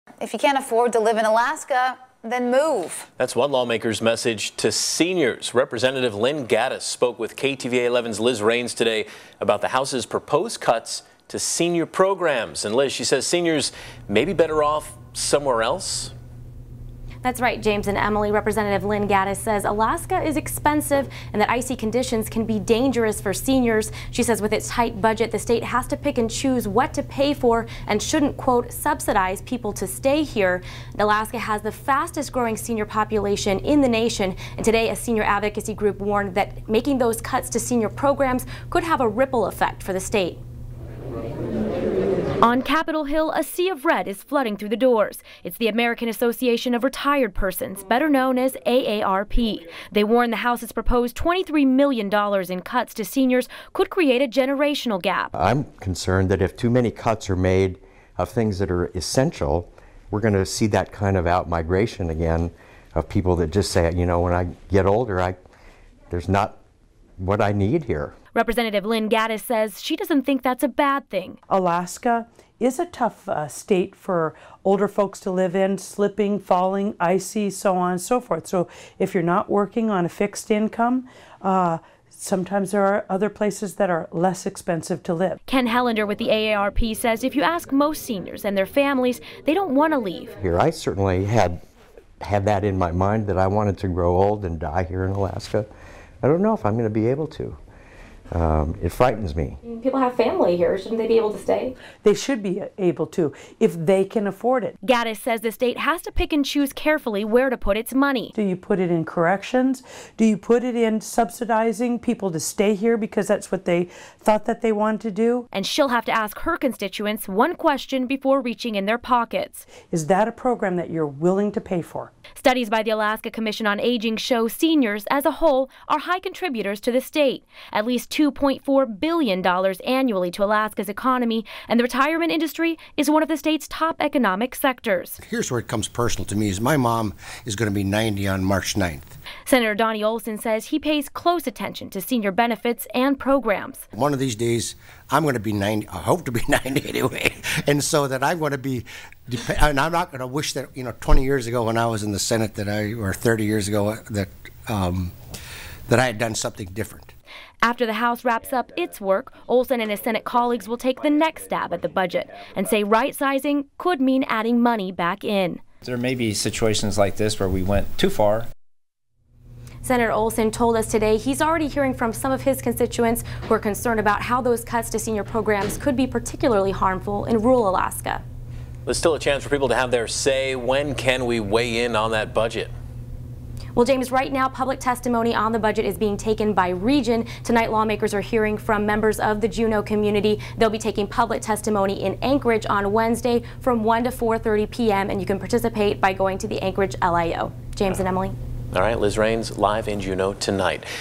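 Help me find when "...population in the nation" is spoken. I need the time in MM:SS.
00:32.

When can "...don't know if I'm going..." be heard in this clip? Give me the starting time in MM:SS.
01:36.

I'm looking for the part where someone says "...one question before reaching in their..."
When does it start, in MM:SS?
01:57.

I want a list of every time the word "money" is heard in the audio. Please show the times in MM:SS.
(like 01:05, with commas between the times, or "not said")
01:47, 02:44.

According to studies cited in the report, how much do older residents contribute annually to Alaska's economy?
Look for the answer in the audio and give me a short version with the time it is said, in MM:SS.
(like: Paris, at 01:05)
$2.4 billion, at 02:08.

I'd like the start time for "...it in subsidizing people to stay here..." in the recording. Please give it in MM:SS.
01:50.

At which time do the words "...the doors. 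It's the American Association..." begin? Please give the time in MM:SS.
00:44.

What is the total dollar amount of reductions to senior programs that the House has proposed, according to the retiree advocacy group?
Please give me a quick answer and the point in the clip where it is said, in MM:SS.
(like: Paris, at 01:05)
$23 million, at 00:51.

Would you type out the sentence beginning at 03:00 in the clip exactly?
When can we weigh in on that budget?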